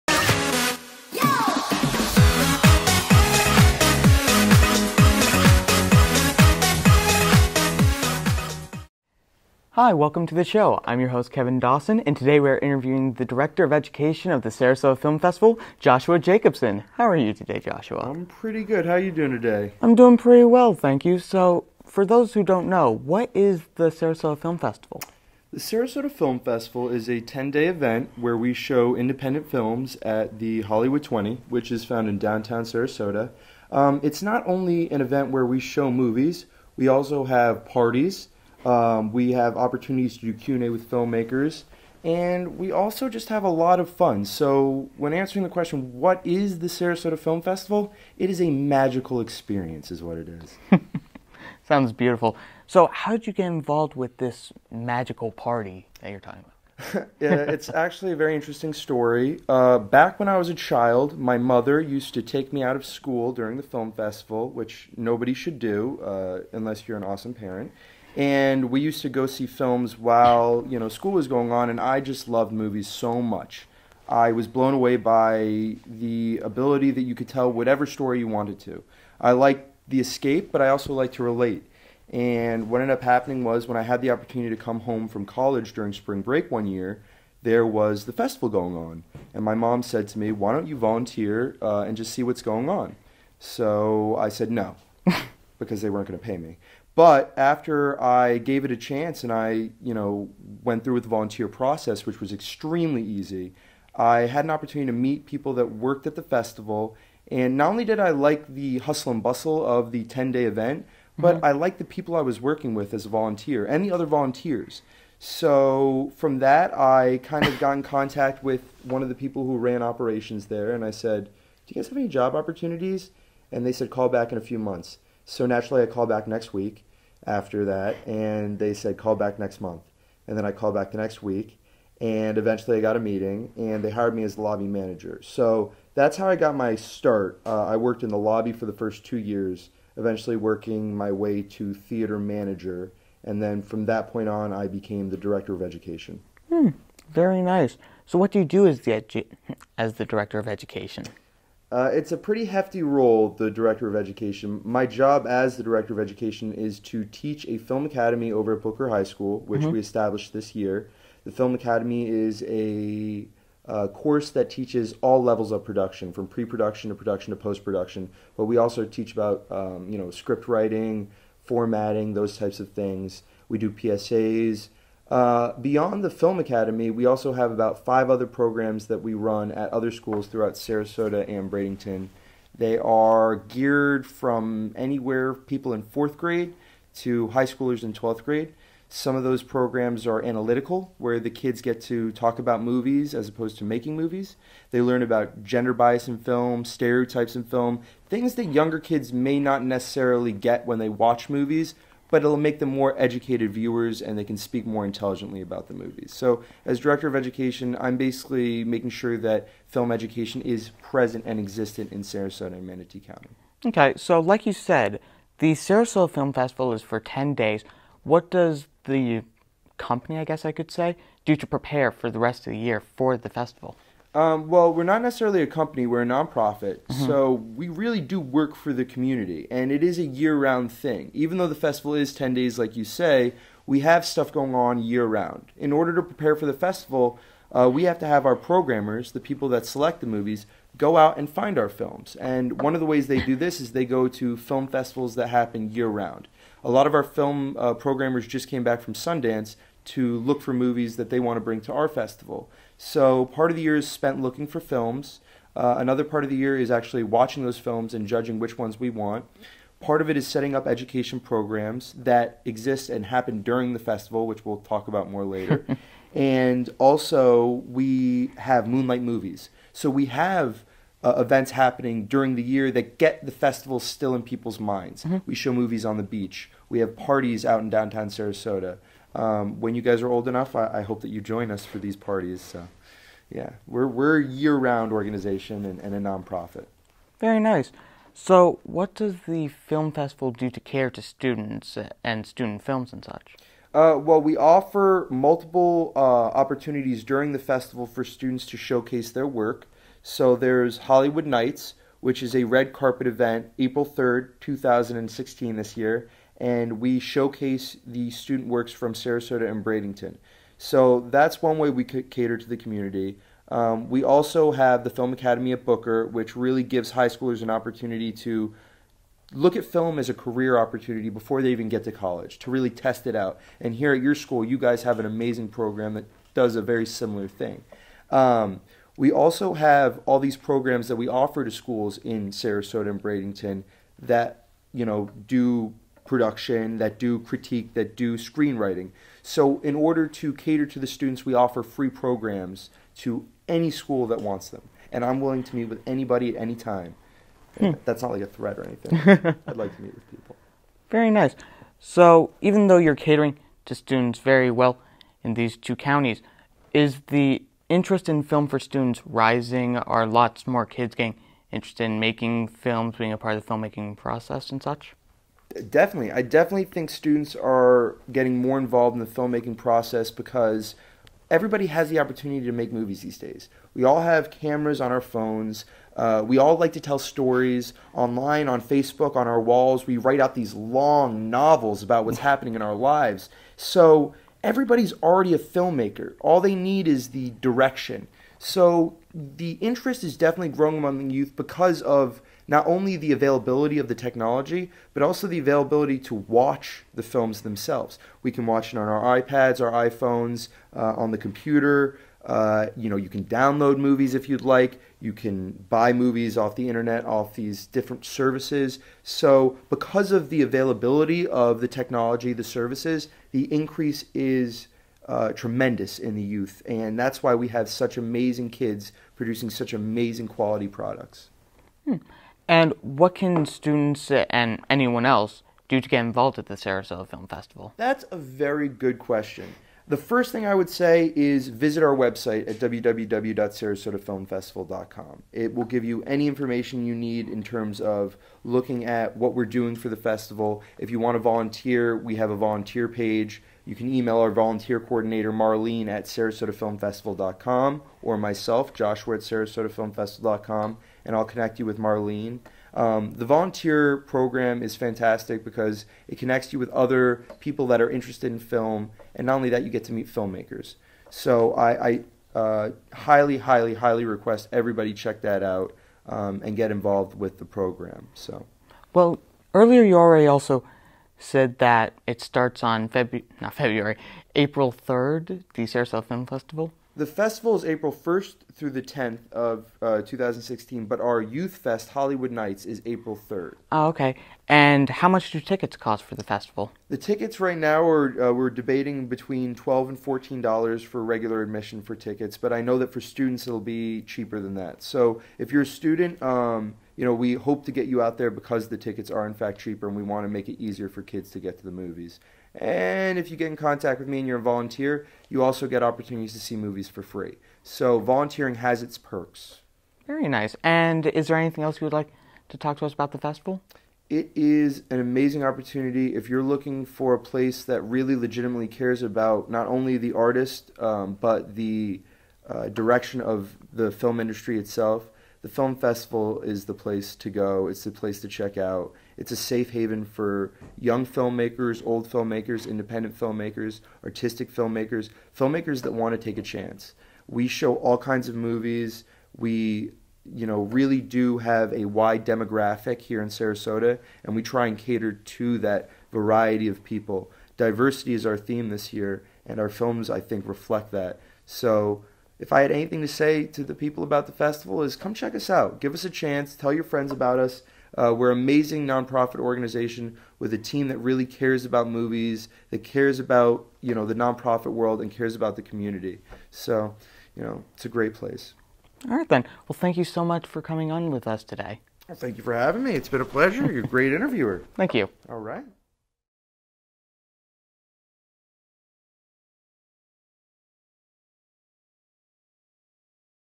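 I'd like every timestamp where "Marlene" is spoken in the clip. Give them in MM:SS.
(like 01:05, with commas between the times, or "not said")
07:25, 07:31.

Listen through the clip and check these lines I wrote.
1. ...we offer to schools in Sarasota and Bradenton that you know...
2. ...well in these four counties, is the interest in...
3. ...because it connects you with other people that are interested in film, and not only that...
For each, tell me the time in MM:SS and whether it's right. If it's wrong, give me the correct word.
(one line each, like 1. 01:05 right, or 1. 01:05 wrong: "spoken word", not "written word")
1. 05:30 right
2. 05:54 wrong: "two", not "four"
3. 07:35 right.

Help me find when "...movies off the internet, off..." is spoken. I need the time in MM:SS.
06:45.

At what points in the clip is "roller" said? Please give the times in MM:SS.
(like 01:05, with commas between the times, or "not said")
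not said.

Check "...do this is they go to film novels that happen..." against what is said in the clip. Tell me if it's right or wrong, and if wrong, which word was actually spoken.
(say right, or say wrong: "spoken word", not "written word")
wrong: "festivals", not "novels".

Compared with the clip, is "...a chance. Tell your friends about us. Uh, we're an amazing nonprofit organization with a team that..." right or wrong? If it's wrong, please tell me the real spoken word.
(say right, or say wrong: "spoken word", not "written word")
right.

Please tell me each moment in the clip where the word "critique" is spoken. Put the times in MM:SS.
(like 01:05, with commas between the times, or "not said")
05:37.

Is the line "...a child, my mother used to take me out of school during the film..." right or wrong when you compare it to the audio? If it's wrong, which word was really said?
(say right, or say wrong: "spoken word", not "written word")
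right.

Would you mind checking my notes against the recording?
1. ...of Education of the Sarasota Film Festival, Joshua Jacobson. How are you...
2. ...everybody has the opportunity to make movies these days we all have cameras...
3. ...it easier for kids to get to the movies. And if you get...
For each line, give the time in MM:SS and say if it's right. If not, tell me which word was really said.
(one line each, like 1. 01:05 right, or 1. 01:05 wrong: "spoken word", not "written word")
1. 00:13 right
2. 06:11 right
3. 08:20 right.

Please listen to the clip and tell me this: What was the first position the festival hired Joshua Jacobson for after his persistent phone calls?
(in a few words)
Lobby manager.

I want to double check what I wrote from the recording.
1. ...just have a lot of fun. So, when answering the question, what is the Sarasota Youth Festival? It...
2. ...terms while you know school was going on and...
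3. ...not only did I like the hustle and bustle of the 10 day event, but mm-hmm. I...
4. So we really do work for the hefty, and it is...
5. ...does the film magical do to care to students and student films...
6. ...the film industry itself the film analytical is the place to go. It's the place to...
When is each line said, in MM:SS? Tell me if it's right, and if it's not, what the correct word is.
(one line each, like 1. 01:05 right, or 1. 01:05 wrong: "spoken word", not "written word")
1. 00:43 wrong: "Film", not "Youth"
2. 01:09 wrong: "films", not "terms"
3. 01:47 right
4. 03:47 wrong: "community", not "hefty"
5. 04:48 wrong: "festival", not "magical"
6. 08:43 wrong: "festival", not "analytical".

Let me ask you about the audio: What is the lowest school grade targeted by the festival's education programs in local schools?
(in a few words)
Fourth grade.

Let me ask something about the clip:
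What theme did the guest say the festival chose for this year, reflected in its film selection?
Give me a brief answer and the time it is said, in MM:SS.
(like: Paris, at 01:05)
Diversity, at 09:07.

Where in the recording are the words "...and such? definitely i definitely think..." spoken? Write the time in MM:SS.
06:04.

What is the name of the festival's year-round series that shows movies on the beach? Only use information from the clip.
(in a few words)
Moonlight Movies.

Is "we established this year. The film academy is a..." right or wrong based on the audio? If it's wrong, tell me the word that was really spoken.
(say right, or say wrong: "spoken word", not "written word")
right.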